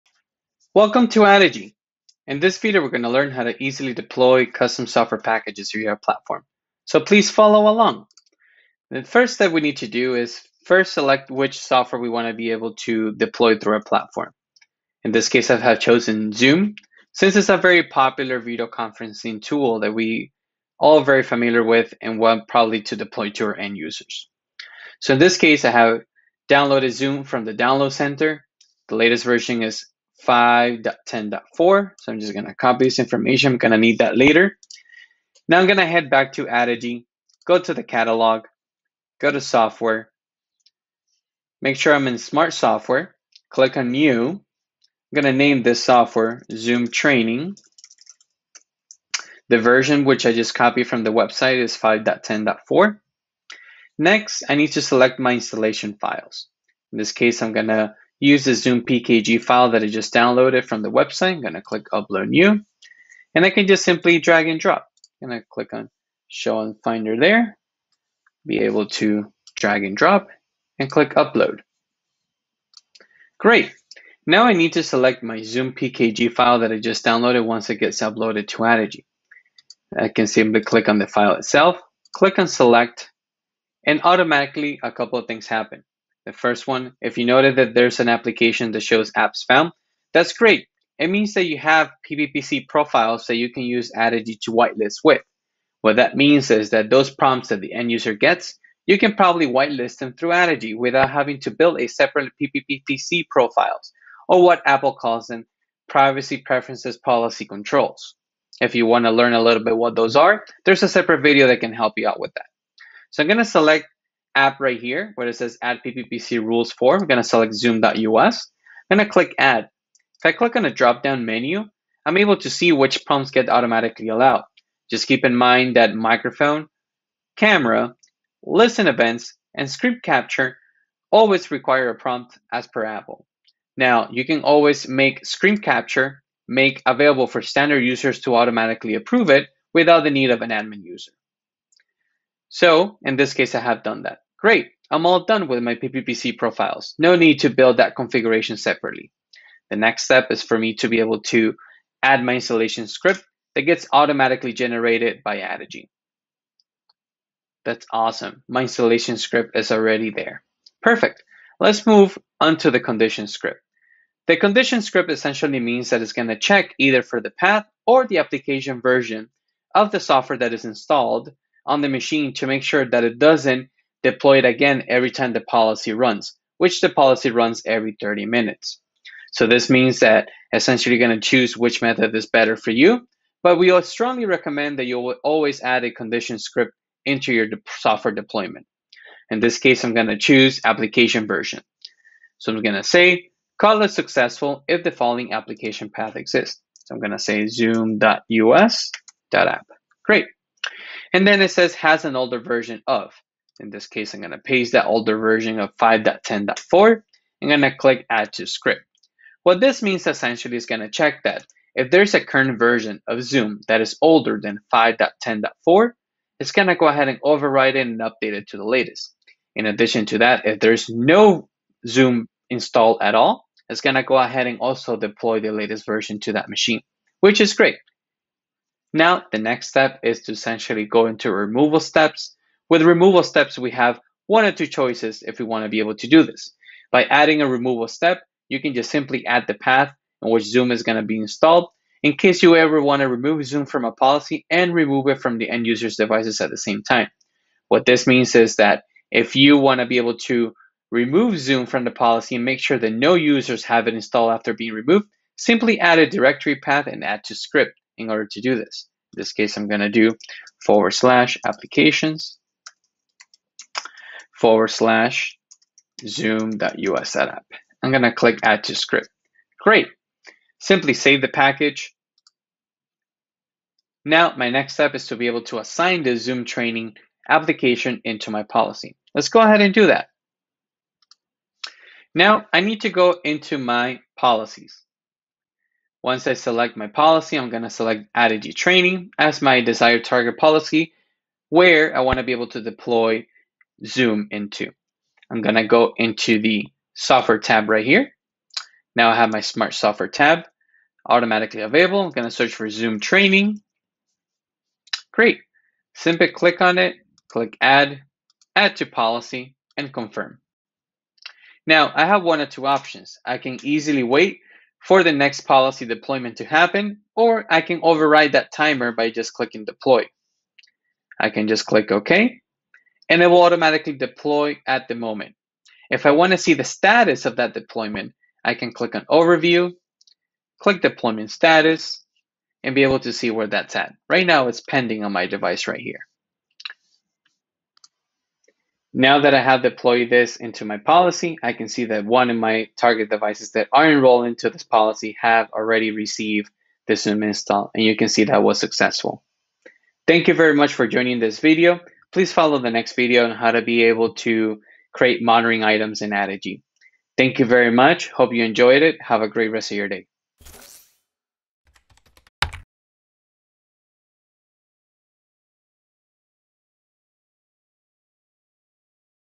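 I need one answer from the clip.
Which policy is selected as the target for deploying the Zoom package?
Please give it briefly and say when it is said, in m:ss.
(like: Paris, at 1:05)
Addigy Training, at 4:48.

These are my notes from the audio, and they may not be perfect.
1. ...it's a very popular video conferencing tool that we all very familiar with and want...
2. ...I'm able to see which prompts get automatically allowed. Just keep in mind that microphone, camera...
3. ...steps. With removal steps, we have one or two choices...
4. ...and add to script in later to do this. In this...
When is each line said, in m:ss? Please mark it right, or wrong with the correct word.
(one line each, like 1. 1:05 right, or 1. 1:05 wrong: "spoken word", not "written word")
1. 0:17 right
2. 2:02 right
3. 3:51 right
4. 4:16 wrong: "order", not "later".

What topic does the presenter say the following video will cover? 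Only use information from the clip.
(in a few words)
monitoring items.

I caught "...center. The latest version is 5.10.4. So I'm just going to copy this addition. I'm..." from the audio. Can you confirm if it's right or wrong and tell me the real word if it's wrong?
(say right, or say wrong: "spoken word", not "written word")
wrong: "information", not "addition".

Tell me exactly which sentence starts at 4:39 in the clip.
Let's go ahead and do that.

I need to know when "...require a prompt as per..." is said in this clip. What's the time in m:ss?
2:11.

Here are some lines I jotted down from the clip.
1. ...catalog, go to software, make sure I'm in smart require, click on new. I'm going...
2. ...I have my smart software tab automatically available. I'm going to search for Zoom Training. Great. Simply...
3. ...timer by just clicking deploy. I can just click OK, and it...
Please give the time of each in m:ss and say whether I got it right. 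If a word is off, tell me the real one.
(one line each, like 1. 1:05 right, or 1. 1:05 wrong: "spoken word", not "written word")
1. 0:37 wrong: "software", not "require"
2. 4:59 right
3. 5:18 right.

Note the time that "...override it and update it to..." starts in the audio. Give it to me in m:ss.
3:37.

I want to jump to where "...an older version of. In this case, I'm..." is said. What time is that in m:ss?
3:22.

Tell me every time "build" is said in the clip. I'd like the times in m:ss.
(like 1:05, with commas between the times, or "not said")
1:41, 2:27.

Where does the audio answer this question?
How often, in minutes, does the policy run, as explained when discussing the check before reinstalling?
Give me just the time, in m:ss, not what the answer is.
2:57.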